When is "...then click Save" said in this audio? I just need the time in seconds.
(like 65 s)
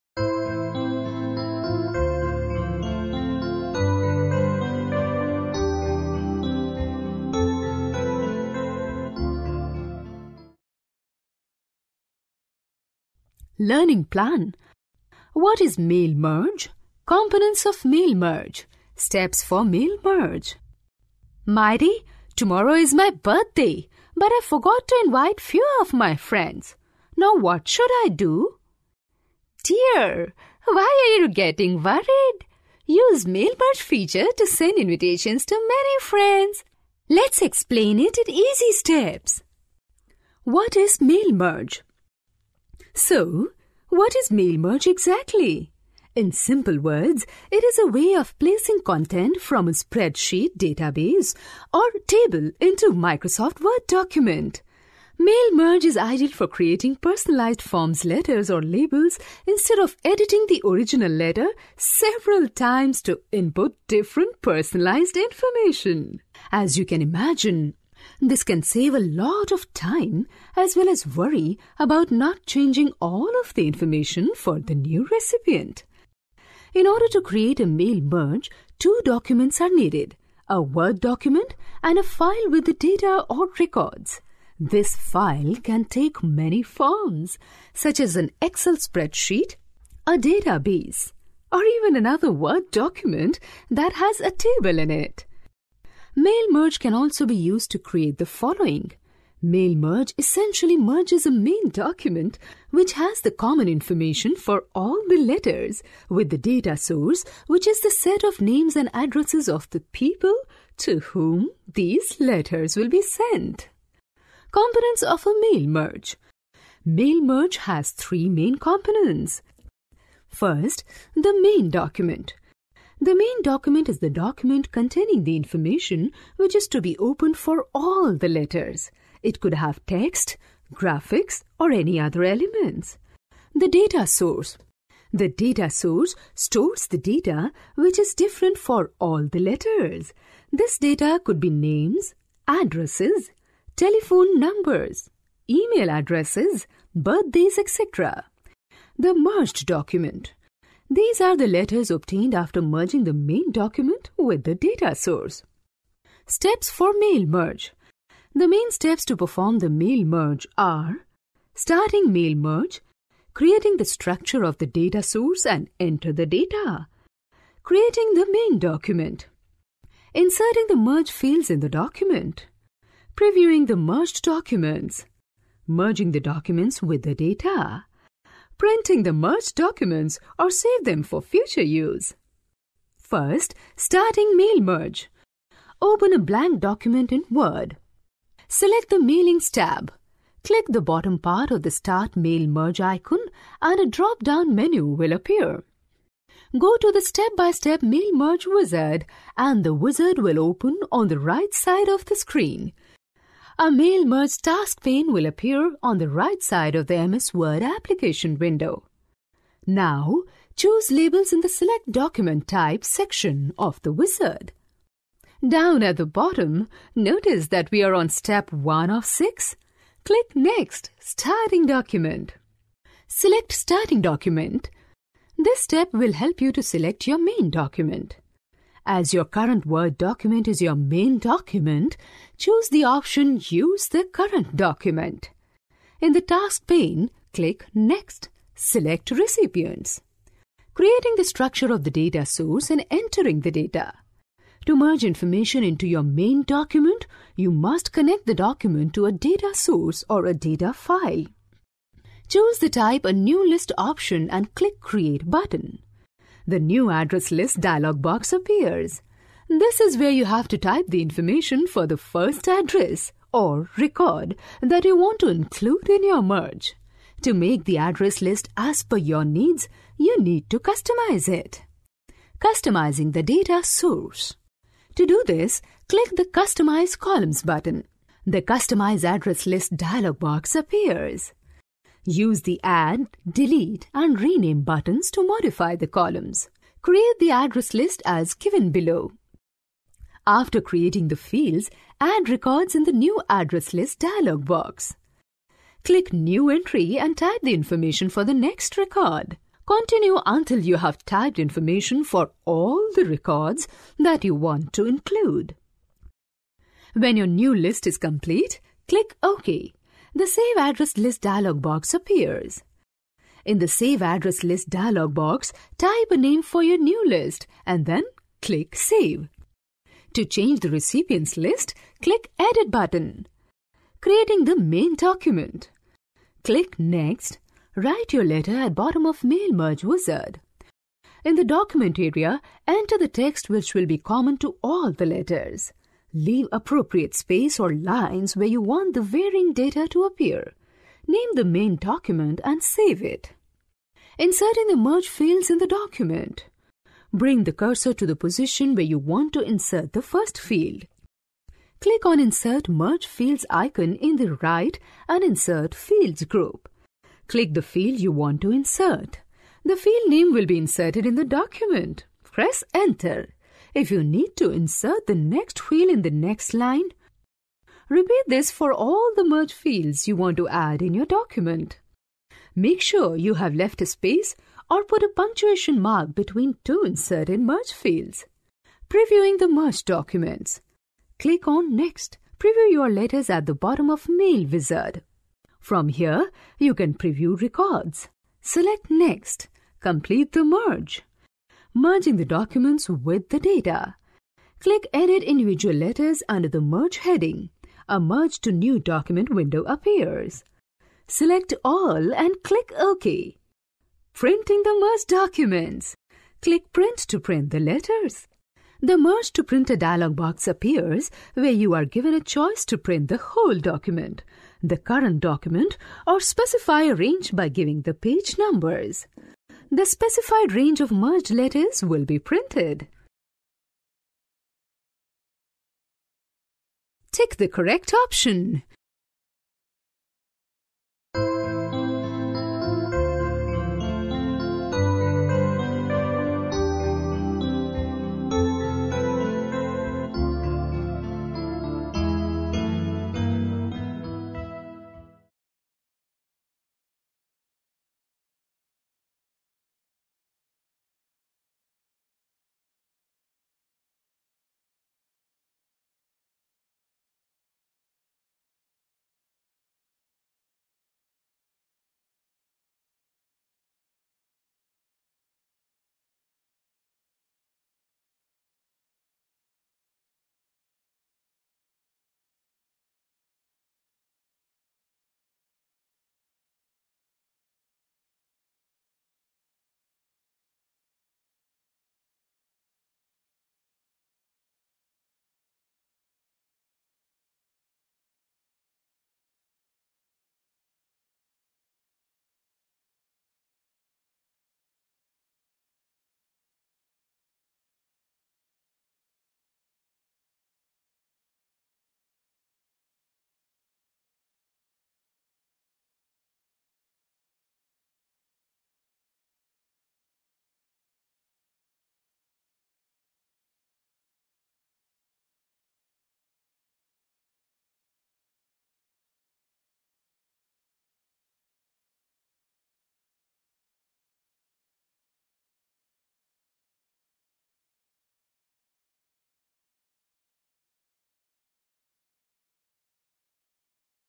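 317 s.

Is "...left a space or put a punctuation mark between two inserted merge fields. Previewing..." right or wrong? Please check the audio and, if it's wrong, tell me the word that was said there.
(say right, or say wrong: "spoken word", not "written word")
right.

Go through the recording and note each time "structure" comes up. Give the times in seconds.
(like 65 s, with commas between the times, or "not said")
163 s, 241 s.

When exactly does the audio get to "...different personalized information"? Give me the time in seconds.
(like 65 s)
63 s.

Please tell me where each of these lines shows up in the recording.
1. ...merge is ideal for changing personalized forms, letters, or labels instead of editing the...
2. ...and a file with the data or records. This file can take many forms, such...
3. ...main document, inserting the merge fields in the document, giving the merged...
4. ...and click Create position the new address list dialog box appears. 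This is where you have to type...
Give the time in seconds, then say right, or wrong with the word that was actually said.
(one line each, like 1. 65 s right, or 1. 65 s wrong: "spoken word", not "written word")
1. 55 s wrong: "creating", not "changing"
2. 81 s right
3. 168 s wrong: "previewing", not "giving"
4. 254 s wrong: "button", not "position".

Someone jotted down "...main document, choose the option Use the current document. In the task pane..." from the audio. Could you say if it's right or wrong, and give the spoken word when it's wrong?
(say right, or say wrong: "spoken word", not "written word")
right.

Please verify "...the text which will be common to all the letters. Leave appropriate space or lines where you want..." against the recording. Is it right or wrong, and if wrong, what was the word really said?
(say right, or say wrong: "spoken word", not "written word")
right.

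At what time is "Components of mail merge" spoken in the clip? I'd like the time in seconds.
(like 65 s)
17 s.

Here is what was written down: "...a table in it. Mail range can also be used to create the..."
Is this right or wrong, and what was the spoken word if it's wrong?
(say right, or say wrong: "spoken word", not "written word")
wrong: "merge", not "range".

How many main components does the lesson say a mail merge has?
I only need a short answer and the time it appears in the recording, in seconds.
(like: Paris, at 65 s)
3, at 117 s.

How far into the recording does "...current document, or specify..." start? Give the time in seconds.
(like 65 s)
414 s.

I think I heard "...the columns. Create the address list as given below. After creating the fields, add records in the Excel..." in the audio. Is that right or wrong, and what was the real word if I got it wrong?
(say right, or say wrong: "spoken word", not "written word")
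wrong: "New", not "Excel".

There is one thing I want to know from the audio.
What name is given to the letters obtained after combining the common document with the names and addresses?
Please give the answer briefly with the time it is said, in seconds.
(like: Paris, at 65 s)
The merged document, at 148 s.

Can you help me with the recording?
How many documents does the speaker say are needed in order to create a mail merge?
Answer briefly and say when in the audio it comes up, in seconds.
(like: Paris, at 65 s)
2, at 78 s.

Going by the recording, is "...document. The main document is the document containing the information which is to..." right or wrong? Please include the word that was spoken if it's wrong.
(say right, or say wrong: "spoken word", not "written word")
right.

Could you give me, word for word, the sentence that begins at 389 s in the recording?
Complete the merge merging the documents with the data.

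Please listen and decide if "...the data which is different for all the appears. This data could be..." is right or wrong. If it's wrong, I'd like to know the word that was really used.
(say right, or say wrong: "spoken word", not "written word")
wrong: "letters", not "appears".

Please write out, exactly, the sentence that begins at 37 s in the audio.
Let's explain it in easy steps.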